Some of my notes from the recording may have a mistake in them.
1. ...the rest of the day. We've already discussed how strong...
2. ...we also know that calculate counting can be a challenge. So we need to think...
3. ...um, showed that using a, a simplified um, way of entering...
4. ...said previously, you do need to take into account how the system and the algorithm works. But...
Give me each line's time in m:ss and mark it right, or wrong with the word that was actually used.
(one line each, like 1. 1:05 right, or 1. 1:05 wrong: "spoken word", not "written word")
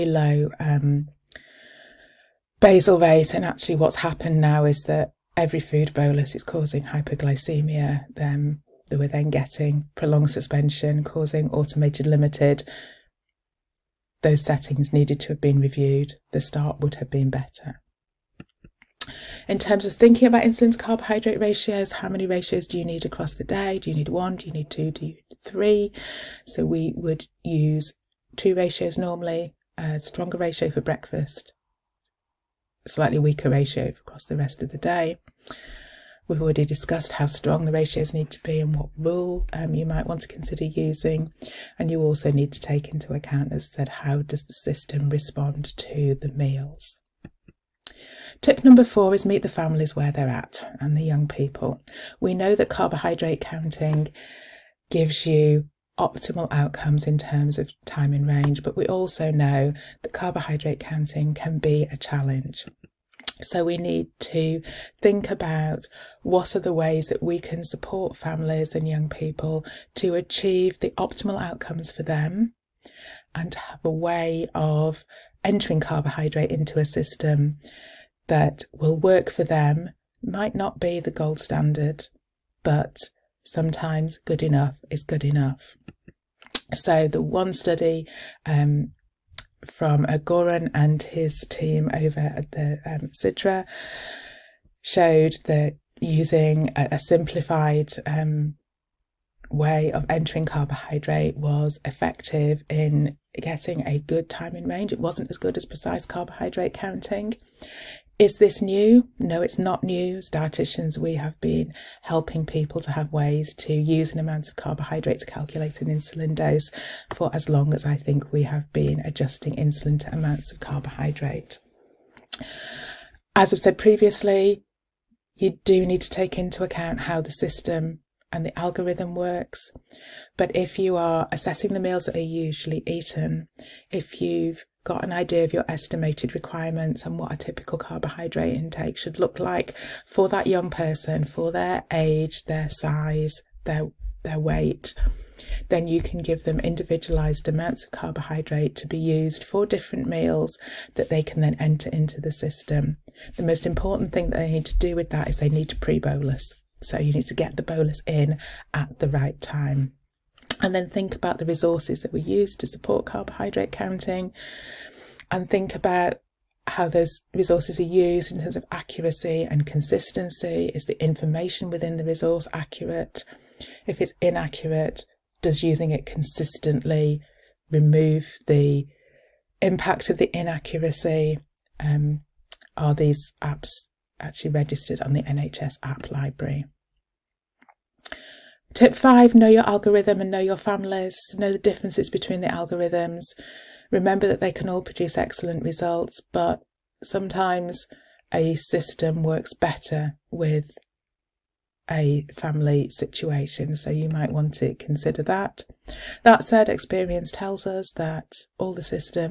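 1. 0:34 right
2. 0:58 wrong: "carbohydrate", not "calculate"
3. 1:32 right
4. 2:03 right.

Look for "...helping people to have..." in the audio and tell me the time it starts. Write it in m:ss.
1:52.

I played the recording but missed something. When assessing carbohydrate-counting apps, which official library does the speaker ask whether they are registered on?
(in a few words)
NHS app library.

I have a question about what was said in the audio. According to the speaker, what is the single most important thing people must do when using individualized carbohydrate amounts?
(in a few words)
Pre bolus.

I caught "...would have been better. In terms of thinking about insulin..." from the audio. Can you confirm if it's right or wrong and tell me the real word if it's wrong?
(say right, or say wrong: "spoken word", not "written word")
right.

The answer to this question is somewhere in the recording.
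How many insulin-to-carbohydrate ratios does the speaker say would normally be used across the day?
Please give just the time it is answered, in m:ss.
0:28.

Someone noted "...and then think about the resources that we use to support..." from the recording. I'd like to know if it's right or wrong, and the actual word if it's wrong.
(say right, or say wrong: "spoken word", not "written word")
right.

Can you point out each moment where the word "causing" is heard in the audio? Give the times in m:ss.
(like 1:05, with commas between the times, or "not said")
0:06, 0:11.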